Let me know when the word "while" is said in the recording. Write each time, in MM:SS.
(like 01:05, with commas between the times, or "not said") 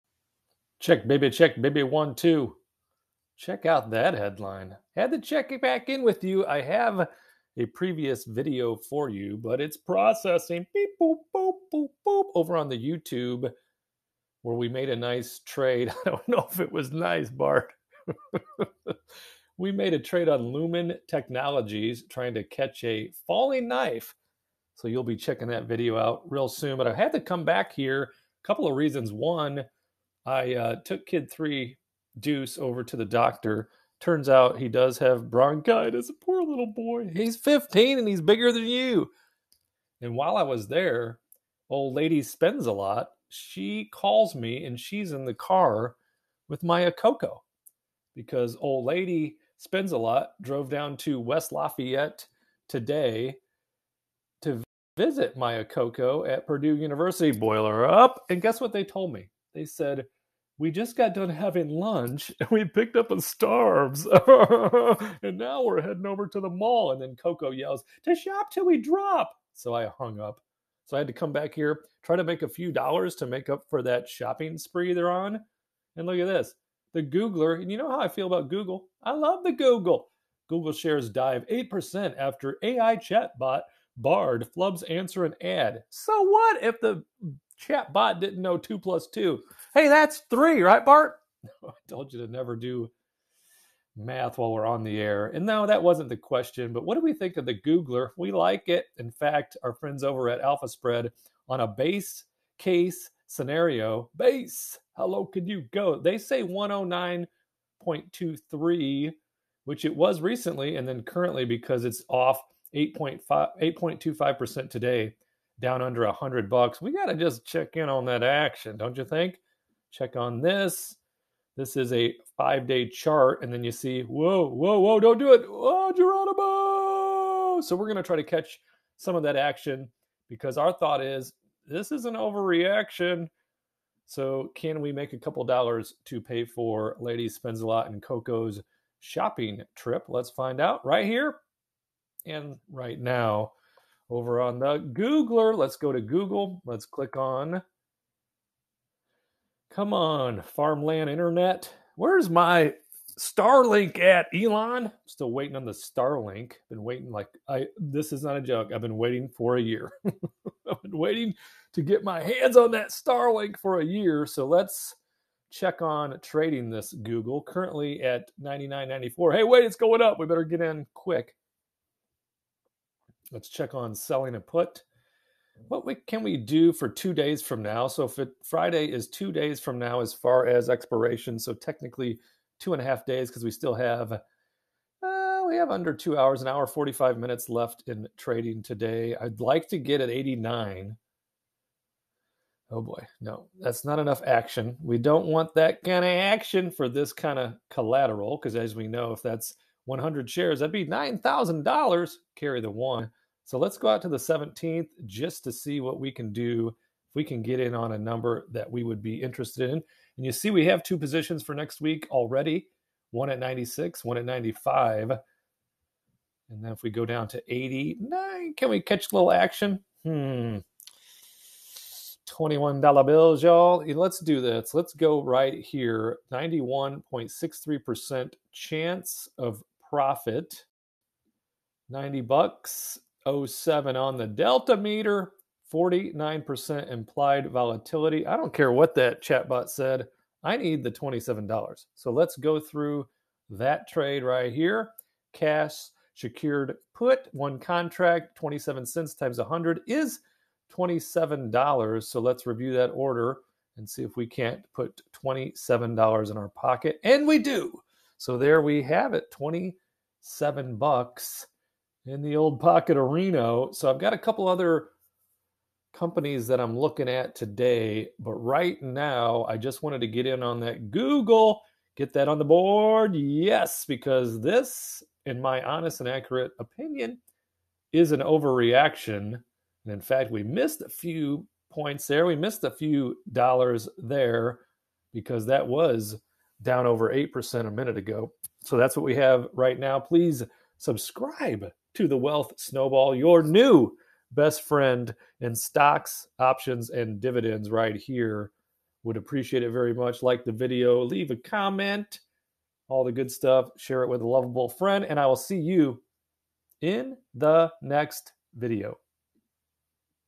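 00:40, 01:34.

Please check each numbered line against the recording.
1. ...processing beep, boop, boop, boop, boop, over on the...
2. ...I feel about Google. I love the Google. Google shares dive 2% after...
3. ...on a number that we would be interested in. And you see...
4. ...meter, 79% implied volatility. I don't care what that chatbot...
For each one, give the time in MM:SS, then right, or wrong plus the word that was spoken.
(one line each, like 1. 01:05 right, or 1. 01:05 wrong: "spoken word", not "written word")
1. 00:09 right
2. 01:18 wrong: "8", not "2"
3. 03:27 right
4. 03:54 wrong: "49", not "79".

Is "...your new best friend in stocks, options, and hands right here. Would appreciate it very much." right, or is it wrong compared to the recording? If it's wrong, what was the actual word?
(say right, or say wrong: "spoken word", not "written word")
wrong: "dividends", not "hands".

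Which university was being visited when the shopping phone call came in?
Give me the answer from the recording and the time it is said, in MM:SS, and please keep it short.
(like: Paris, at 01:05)
Purdue University, at 00:56.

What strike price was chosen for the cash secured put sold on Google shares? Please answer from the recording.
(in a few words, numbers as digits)
89.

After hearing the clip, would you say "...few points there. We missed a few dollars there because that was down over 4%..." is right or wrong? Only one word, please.
wrong.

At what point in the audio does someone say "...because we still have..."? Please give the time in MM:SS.
03:03.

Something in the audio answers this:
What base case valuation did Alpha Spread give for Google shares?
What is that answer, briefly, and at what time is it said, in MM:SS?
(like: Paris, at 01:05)
109.23, at 01:46.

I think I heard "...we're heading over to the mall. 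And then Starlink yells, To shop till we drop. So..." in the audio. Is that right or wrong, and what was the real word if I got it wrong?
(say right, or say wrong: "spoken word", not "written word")
wrong: "Coco", not "Starlink".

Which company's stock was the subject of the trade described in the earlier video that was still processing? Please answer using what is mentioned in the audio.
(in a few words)
Lumen Technologies.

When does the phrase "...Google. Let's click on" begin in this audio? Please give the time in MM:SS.
02:26.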